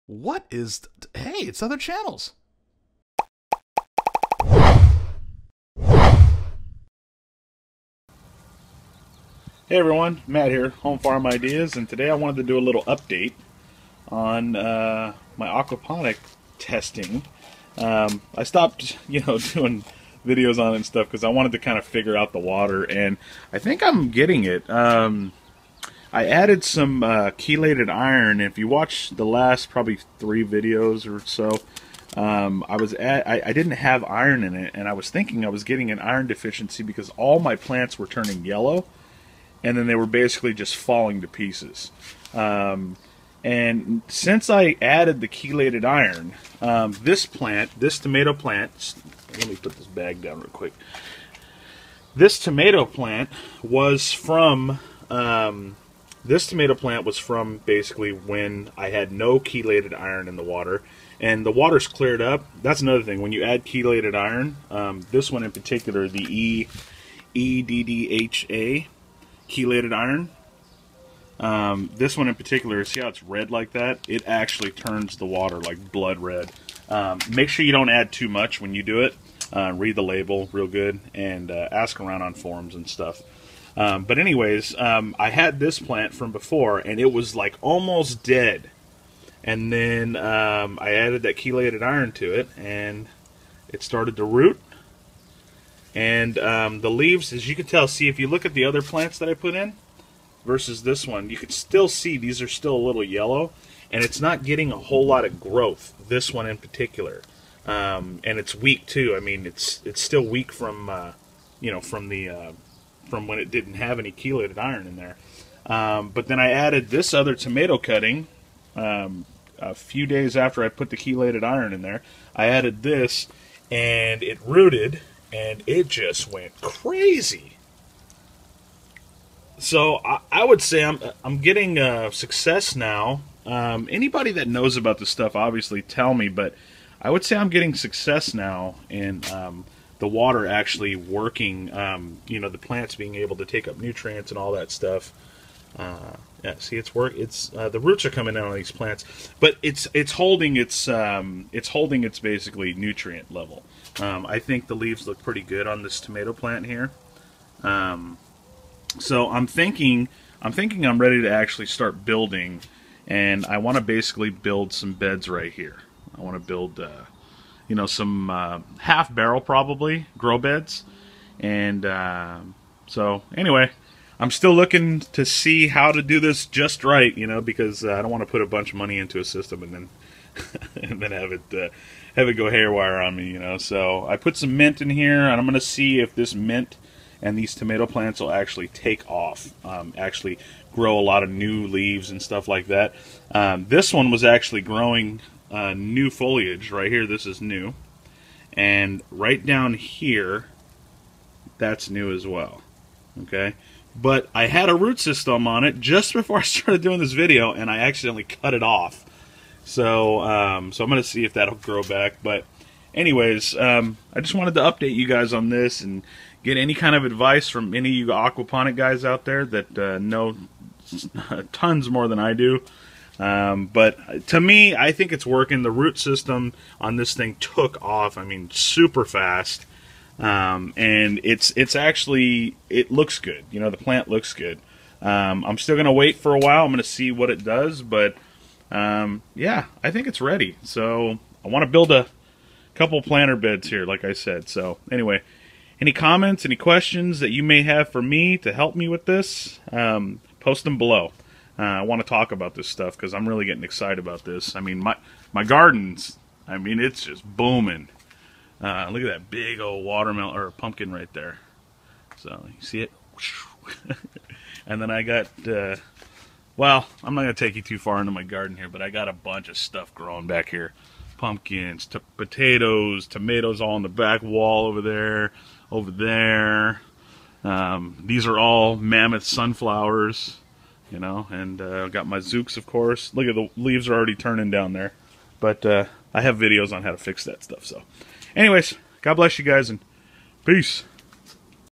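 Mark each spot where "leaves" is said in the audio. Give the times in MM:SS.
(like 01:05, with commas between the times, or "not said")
01:36, 02:34, 03:11, 04:43.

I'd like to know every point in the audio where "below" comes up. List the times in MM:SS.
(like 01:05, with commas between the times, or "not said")
04:10.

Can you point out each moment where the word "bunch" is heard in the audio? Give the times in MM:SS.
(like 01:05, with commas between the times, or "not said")
02:58, 04:29.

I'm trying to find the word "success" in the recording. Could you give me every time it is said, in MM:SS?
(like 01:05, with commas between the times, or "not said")
02:12, 02:17.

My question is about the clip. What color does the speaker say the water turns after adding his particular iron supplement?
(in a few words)
Blood red.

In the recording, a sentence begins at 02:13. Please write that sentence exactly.
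Um, anybody that knows about this stuff, obviously, tell me.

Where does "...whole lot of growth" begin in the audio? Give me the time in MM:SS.
01:44.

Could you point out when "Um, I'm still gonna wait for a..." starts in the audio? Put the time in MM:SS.
03:55.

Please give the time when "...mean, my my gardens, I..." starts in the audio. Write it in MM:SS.
04:14.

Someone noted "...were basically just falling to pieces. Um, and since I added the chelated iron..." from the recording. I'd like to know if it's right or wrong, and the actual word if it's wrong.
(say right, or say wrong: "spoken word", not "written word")
right.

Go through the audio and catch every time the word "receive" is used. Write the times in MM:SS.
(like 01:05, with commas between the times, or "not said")
not said.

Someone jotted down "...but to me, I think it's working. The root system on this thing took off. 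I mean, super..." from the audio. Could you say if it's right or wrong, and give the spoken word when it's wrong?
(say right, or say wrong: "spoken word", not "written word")
right.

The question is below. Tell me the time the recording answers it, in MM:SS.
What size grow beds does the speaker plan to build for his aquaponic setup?
02:48.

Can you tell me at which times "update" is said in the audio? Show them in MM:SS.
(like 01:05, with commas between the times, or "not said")
00:12, 03:34.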